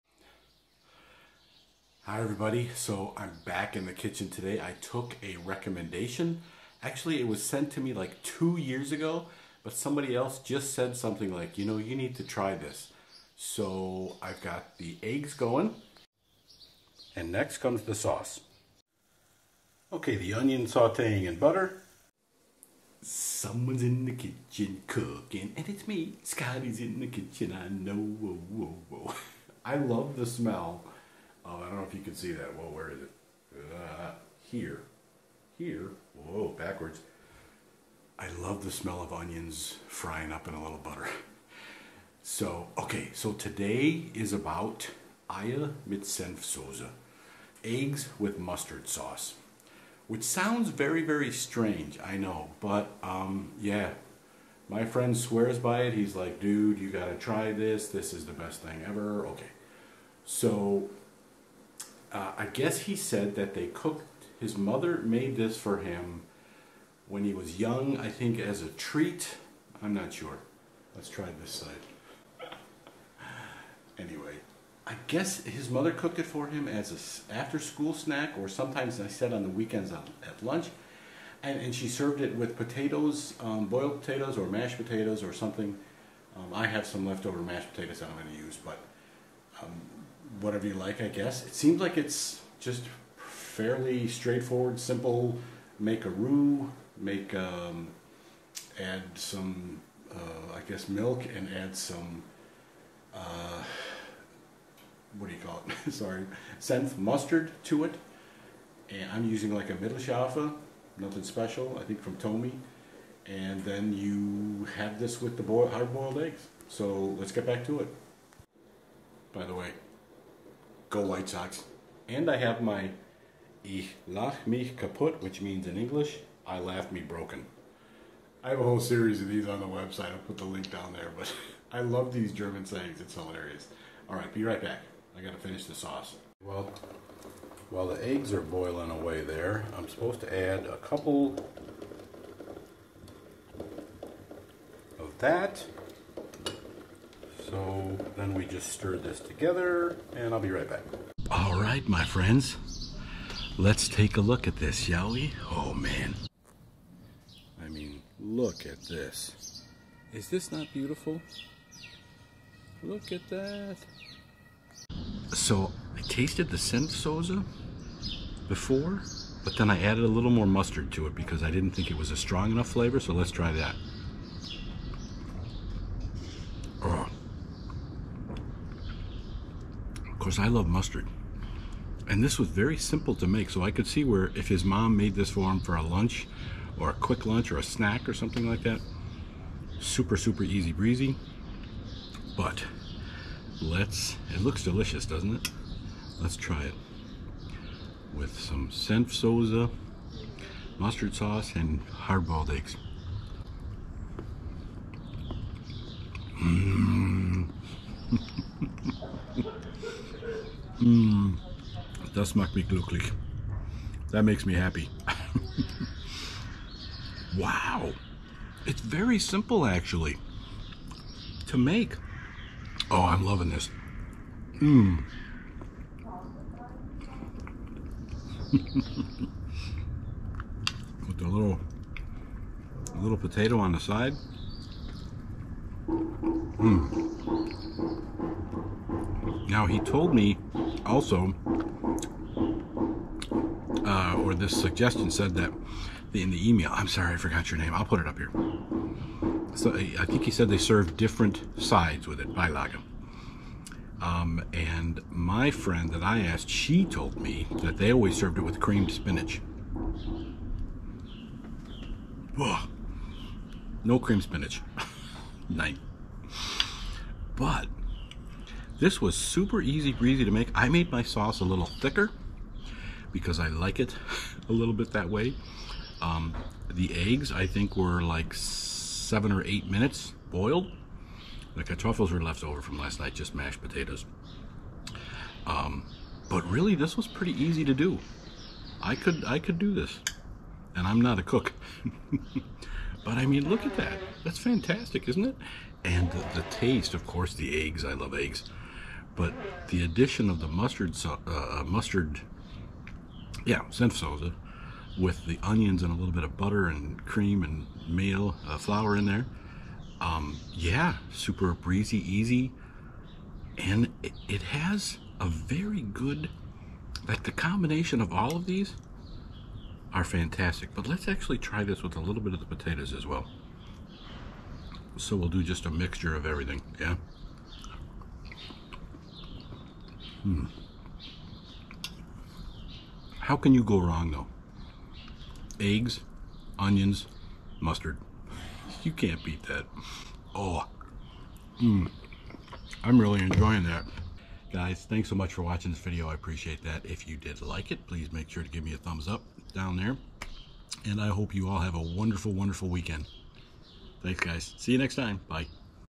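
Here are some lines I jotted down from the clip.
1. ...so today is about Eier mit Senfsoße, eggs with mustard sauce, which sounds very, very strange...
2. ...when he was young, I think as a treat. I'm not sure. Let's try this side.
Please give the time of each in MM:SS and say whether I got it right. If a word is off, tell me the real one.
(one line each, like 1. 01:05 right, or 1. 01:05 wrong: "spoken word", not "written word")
1. 00:43 right
2. 01:07 right.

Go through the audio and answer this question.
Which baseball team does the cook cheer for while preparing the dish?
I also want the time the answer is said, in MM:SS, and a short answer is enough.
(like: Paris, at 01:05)
White Sox, at 02:00.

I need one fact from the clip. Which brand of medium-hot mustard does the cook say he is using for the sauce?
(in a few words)
Thomy.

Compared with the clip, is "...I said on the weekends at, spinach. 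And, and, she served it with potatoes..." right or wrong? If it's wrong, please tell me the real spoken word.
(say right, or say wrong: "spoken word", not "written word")
wrong: "lunch", not "spinach".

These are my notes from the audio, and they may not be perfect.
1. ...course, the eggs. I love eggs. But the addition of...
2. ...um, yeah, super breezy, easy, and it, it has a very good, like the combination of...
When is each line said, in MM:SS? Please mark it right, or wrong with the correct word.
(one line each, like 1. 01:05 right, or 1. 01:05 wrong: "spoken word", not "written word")
1. 04:57 right
2. 05:09 right.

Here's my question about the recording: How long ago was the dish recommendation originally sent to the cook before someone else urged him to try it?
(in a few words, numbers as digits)
2 years.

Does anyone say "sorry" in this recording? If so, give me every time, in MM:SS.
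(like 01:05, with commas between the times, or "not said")
01:45, 04:06.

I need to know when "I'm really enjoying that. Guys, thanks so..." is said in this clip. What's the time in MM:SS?
05:42.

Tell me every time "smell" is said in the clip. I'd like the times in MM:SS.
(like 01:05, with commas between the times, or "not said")
00:30, 00:38.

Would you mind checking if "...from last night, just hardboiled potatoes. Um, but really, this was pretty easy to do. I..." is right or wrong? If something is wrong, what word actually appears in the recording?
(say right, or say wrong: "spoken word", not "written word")
wrong: "mashed", not "hardboiled".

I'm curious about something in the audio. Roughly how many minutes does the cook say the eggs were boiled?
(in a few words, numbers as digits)
7 or 8 minutes.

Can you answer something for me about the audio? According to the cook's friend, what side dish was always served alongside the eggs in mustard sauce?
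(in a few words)
Creamed spinach.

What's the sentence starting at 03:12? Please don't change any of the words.
But let's, it looks delicious, doesn't it?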